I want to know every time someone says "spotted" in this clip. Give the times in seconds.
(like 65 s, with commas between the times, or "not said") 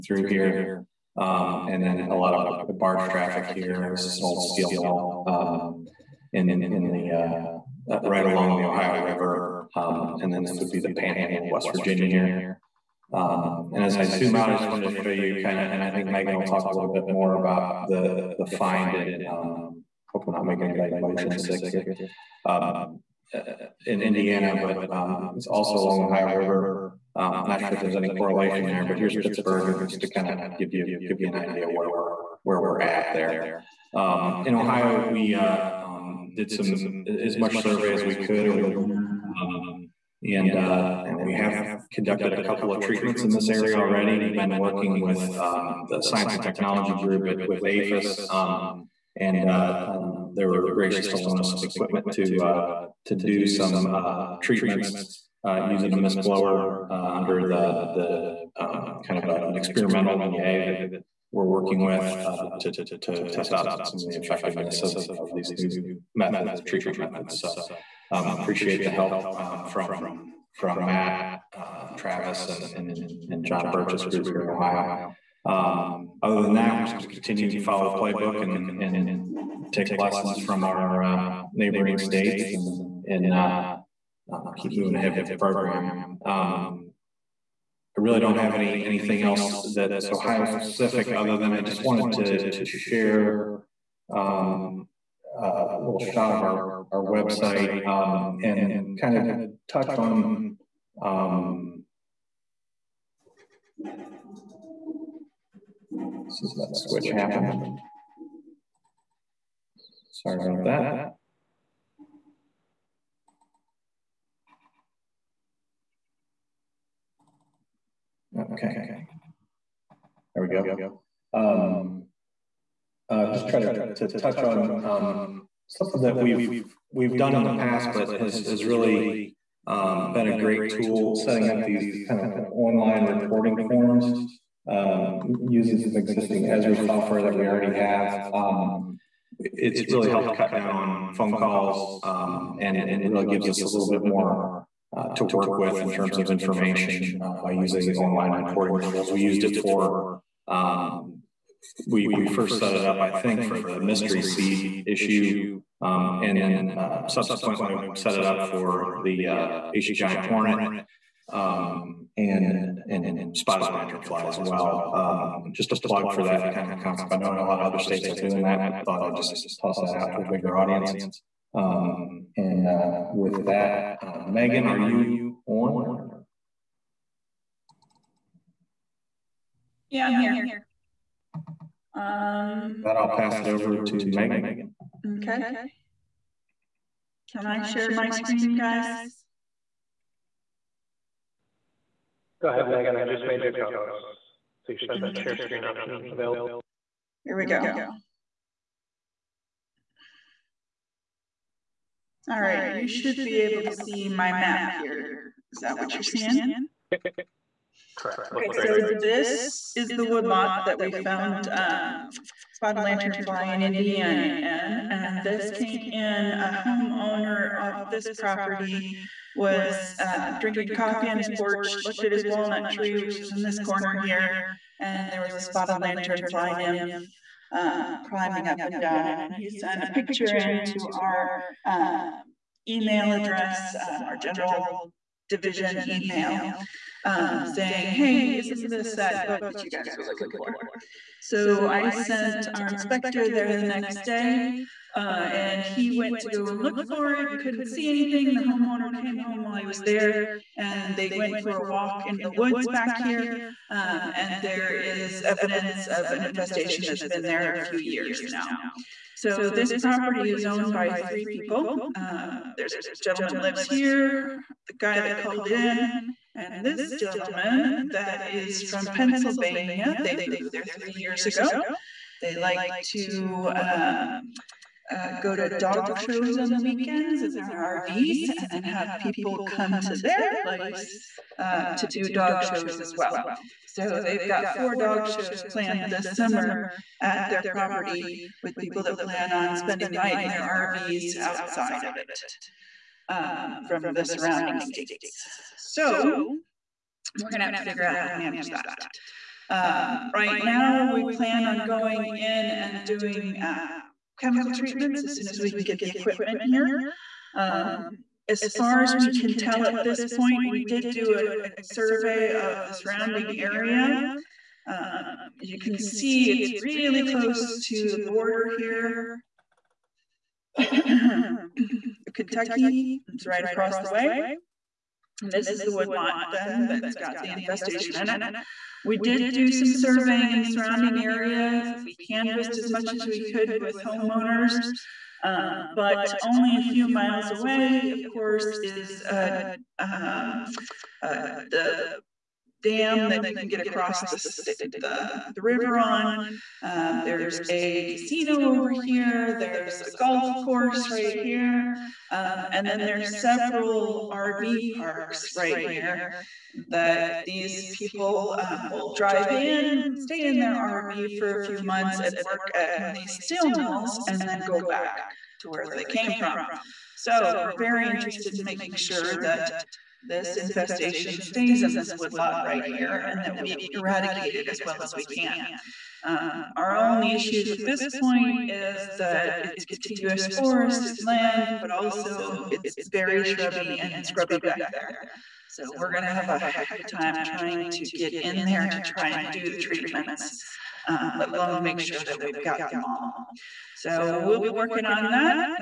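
163 s, 212 s, 225 s.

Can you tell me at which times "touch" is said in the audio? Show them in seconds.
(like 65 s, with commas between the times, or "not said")
99 s, 124 s.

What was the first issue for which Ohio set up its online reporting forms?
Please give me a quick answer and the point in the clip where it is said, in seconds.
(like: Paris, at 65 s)
Mystery seed issue, at 153 s.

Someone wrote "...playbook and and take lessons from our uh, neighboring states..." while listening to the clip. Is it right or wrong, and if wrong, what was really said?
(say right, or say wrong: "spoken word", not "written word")
right.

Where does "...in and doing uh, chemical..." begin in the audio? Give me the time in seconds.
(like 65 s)
302 s.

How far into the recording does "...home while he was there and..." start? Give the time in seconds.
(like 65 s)
249 s.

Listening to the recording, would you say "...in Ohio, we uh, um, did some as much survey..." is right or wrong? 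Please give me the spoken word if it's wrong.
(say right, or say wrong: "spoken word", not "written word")
right.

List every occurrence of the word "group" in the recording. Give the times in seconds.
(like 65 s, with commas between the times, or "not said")
46 s, 74 s.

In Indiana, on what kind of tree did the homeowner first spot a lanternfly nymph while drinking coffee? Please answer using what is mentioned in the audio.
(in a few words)
Walnut tree.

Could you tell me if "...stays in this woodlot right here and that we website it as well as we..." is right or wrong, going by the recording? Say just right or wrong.
wrong.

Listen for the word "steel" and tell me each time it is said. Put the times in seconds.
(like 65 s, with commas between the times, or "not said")
4 s, 363 s.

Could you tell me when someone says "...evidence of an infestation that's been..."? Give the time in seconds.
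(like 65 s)
255 s.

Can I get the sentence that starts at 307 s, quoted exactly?
Um, as far as we can tell at this point, we did do a, a survey of the surrounding area.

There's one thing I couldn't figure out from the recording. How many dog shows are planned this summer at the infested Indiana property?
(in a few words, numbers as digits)
4.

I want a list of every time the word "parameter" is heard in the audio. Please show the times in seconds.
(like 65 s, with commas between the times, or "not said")
not said.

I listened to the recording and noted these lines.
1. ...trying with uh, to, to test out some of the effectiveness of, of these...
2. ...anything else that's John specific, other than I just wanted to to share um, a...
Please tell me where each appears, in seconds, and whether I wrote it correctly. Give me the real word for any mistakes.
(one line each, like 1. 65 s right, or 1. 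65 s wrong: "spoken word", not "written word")
1. 61 s wrong: "working", not "trying"
2. 88 s wrong: "Ohio", not "John".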